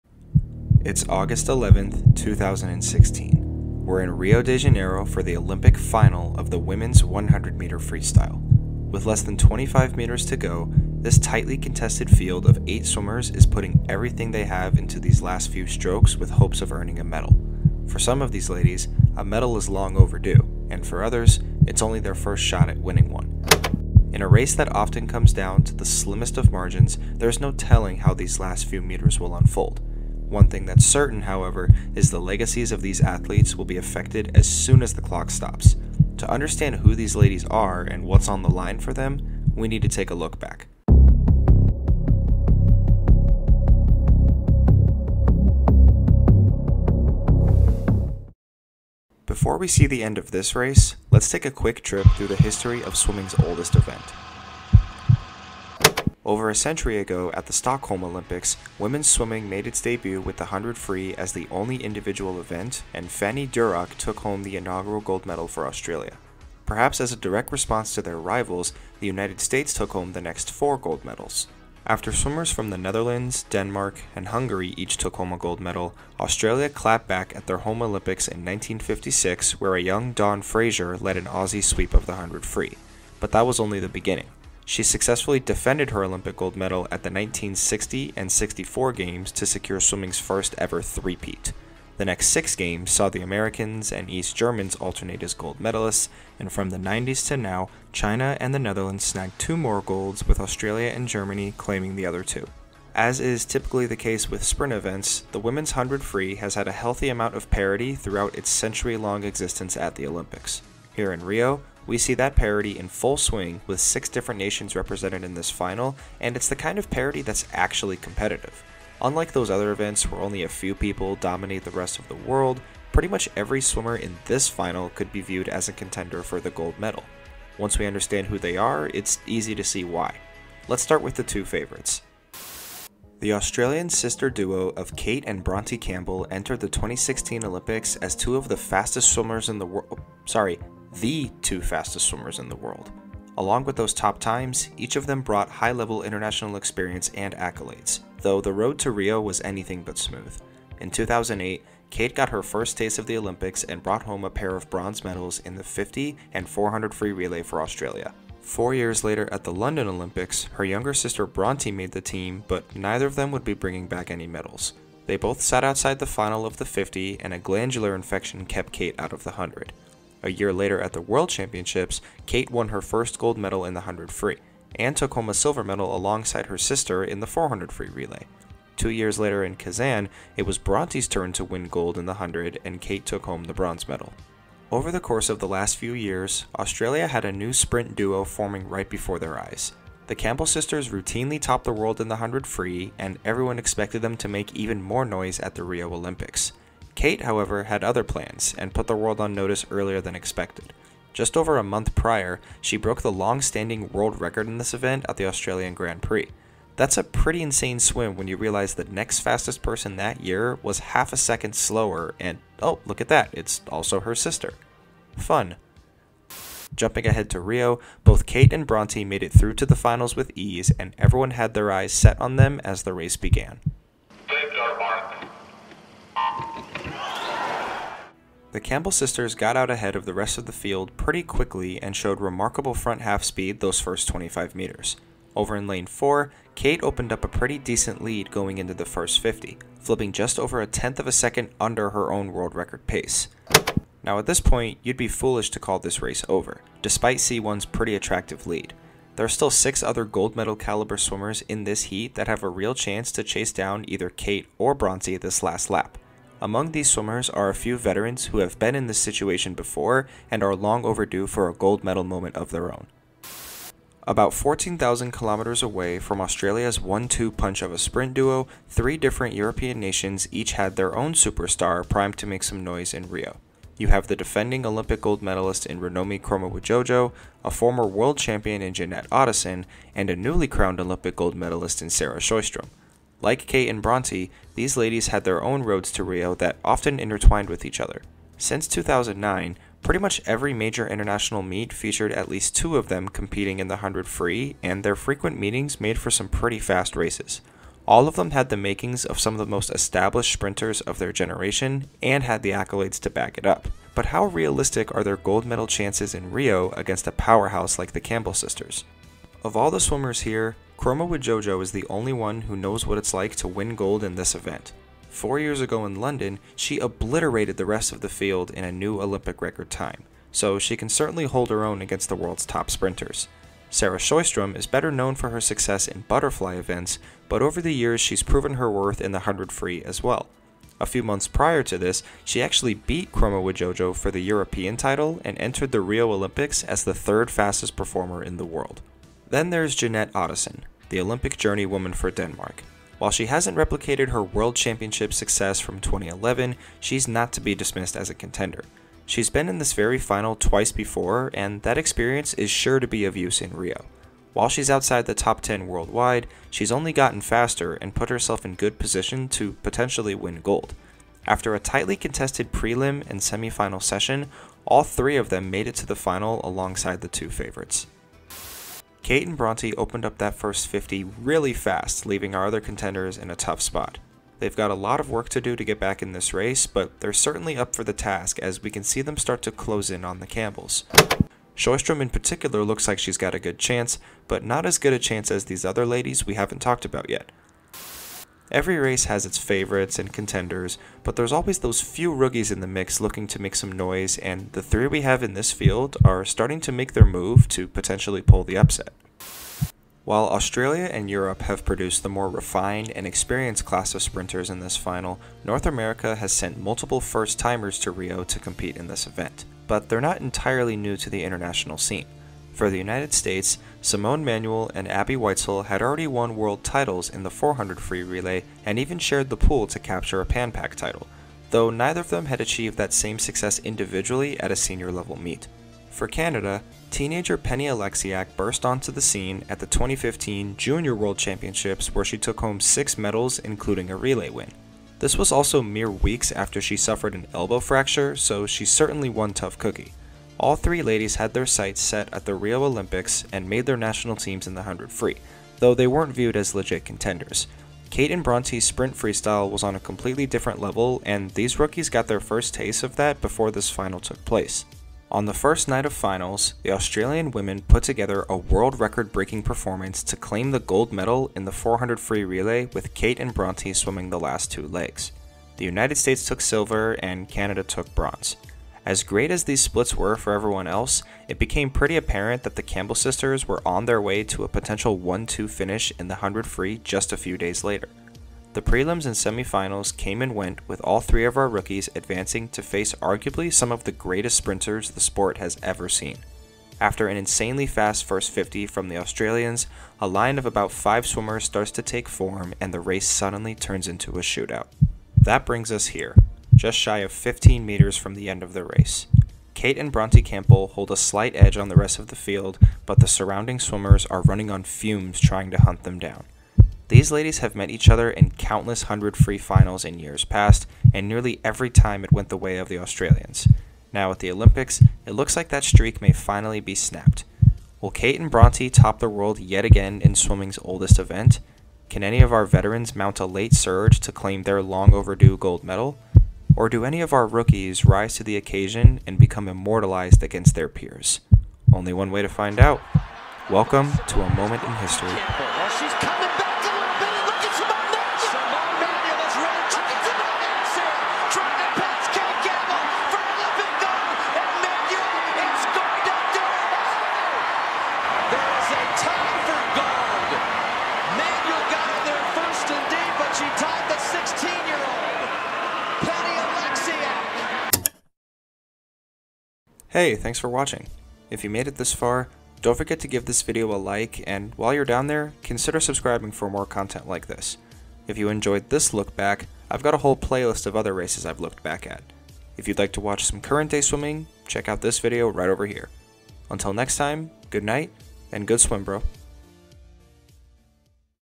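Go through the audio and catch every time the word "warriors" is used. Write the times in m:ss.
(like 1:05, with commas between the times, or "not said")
not said.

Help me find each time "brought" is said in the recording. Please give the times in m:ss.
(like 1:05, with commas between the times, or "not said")
2:25, 2:33.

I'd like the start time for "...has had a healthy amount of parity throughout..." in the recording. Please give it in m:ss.
1:46.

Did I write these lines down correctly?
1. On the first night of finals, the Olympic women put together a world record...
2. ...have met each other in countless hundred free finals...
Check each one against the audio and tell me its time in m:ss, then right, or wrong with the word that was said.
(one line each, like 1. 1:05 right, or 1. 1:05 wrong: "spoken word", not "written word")
1. 7:35 wrong: "Australian", not "Olympic"
2. 8:27 right.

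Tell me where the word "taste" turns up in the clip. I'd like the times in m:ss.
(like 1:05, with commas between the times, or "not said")
2:32, 7:32.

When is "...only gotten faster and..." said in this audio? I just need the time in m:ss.
5:56.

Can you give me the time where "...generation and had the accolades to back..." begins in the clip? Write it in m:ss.
5:01.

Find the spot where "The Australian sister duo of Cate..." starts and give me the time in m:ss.
2:13.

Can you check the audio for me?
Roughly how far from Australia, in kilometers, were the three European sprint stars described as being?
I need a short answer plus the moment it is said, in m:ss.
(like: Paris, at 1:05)
14,000 kilometers, at 4:24.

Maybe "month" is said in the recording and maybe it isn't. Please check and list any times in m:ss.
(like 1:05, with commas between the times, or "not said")
3:21, 5:31.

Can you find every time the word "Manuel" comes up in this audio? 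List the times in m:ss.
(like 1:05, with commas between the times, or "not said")
6:54.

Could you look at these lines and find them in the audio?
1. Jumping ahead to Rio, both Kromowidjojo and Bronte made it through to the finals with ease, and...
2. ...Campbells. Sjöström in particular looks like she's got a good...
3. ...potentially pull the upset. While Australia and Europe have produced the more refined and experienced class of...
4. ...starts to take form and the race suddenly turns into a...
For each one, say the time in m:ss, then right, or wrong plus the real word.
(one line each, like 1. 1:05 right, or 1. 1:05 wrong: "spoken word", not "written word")
1. 3:36 wrong: "Cate", not "Kromowidjojo"
2. 6:20 right
3. 6:37 right
4. 8:11 right.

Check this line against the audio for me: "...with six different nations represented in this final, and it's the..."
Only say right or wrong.
right.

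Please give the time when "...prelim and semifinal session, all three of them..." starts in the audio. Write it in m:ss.
6:02.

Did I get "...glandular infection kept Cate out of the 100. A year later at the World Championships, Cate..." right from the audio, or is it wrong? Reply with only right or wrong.
right.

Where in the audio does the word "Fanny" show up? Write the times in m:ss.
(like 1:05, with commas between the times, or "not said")
1:03.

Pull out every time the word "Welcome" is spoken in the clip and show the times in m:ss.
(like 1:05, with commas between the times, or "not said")
8:53.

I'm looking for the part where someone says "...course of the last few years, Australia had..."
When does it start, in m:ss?
3:05.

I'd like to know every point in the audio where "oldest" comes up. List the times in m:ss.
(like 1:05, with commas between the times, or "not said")
0:53, 8:40.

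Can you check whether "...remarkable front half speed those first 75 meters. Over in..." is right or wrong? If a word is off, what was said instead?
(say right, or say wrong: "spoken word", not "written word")
wrong: "25", not "75".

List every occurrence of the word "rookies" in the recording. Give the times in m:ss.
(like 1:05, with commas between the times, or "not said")
6:32, 7:31, 8:01, 8:47.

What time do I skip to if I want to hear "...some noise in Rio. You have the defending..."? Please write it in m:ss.
4:32.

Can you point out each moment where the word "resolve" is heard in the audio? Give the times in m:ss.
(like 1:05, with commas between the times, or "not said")
not said.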